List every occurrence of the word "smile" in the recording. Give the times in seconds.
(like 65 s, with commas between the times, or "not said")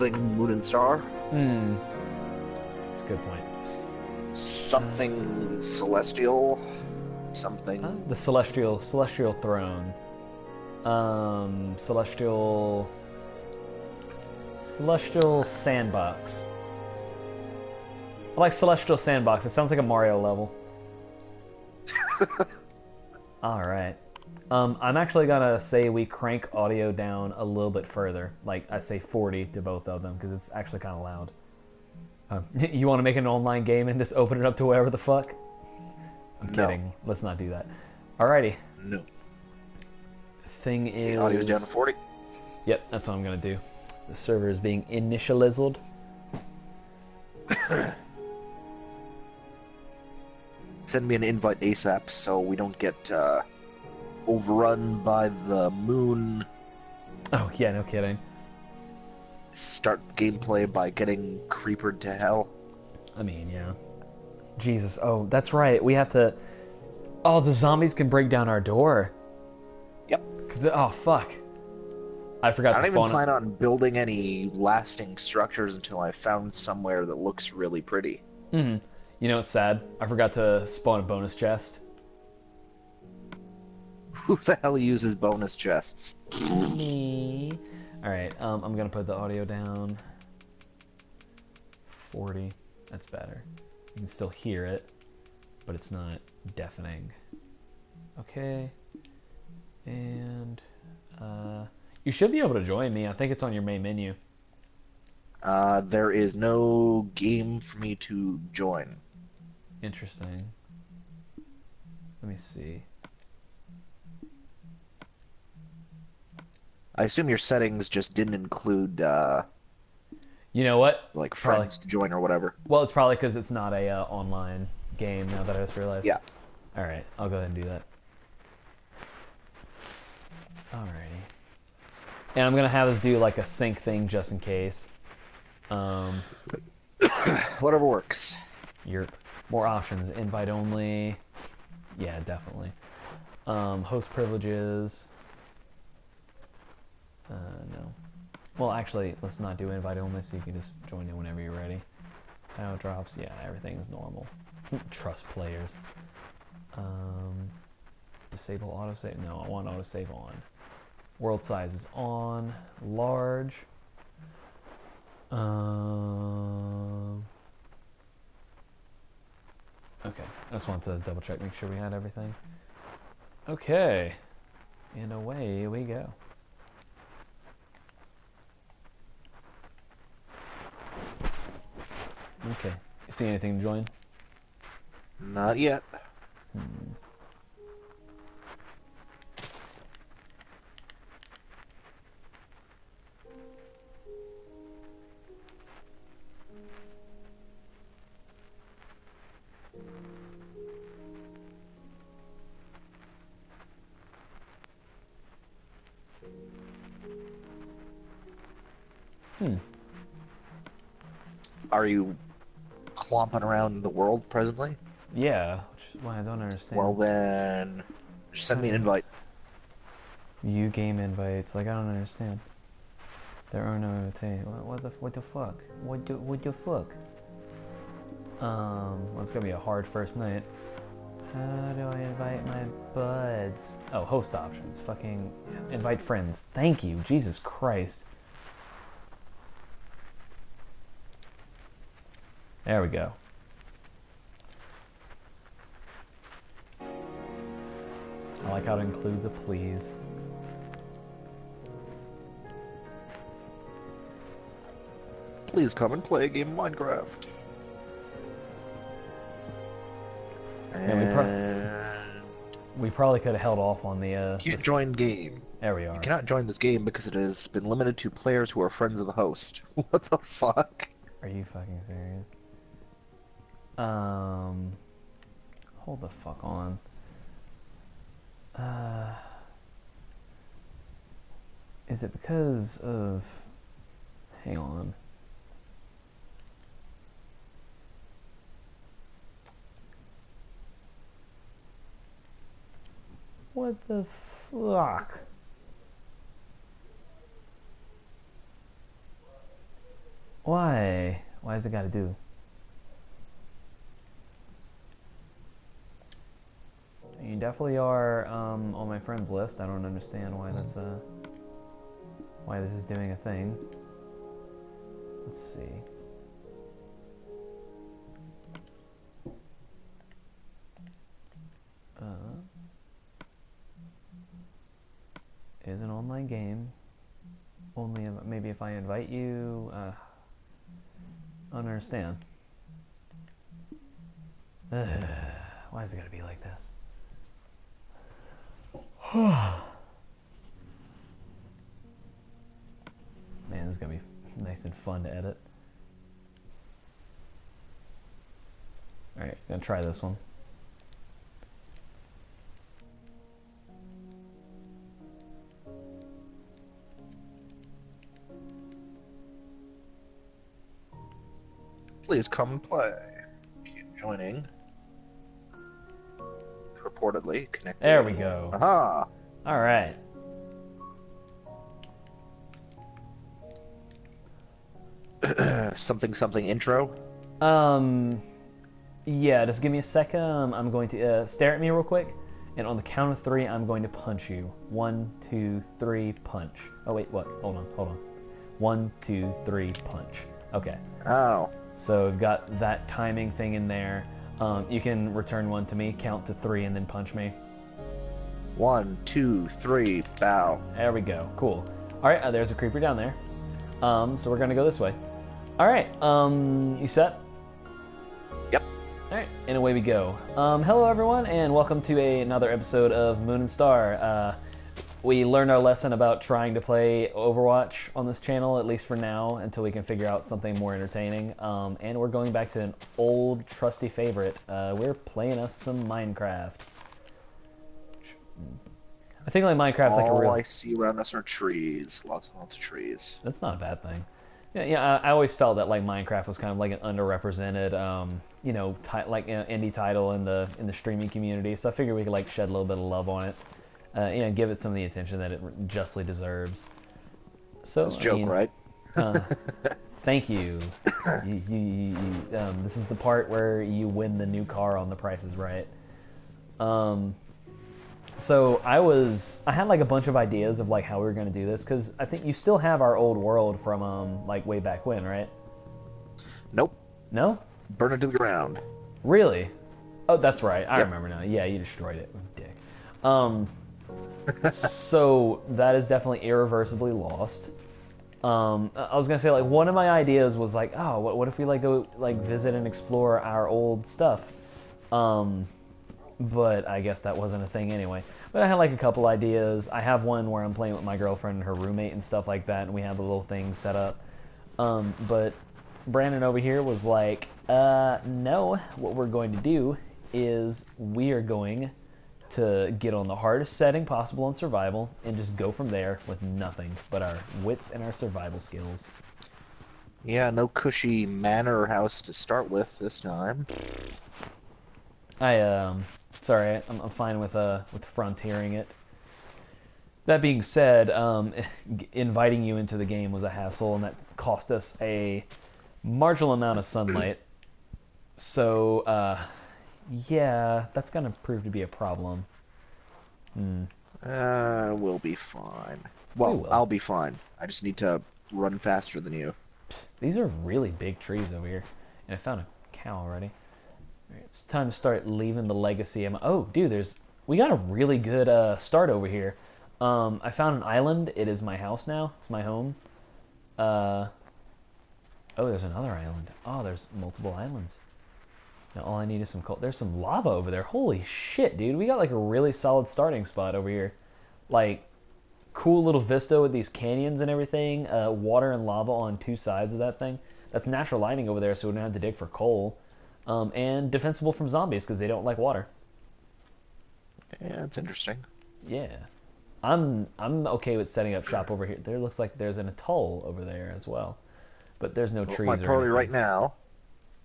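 not said.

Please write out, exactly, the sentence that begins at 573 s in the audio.
Um, and defensible from zombies because they don't like water.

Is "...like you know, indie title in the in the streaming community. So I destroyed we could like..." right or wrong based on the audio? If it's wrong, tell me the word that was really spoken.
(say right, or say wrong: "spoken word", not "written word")
wrong: "figured", not "destroyed".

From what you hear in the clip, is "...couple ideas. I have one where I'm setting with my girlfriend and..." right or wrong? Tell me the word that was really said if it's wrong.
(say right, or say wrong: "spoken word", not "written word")
wrong: "playing", not "setting".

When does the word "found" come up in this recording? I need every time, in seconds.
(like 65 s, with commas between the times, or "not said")
76 s, 542 s, 550 s.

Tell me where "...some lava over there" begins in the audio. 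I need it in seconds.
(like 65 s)
559 s.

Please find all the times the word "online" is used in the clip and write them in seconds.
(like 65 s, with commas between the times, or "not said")
33 s, 124 s, 325 s.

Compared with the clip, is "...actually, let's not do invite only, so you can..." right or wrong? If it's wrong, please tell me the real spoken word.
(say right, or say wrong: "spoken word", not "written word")
right.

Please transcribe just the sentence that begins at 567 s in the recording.
Uh, water and lava on two sides of that thing.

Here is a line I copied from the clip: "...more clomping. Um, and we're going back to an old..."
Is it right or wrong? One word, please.
wrong.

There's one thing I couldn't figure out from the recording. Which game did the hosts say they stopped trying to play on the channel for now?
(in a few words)
Overwatch.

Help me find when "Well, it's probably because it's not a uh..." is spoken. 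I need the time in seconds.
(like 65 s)
122 s.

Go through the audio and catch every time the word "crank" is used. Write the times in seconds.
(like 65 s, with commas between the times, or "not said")
26 s.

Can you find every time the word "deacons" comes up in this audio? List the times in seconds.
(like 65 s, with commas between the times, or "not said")
not said.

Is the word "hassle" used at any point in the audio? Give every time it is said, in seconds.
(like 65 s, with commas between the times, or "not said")
523 s.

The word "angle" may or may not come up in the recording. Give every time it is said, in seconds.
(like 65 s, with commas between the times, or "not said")
not said.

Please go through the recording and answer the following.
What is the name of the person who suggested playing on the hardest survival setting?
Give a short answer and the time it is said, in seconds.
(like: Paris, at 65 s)
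Brandon, at 495 s.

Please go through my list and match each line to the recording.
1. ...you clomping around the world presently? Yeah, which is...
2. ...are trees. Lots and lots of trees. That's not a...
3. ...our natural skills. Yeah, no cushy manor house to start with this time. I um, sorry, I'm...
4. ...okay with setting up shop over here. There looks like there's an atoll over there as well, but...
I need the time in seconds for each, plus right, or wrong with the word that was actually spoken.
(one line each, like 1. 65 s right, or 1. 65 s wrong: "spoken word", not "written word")
1. 211 s right
2. 431 s right
3. 507 s wrong: "survival", not "natural"
4. 580 s right.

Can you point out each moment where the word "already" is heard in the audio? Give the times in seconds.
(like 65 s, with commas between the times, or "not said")
542 s.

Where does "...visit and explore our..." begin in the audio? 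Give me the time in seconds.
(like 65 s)
482 s.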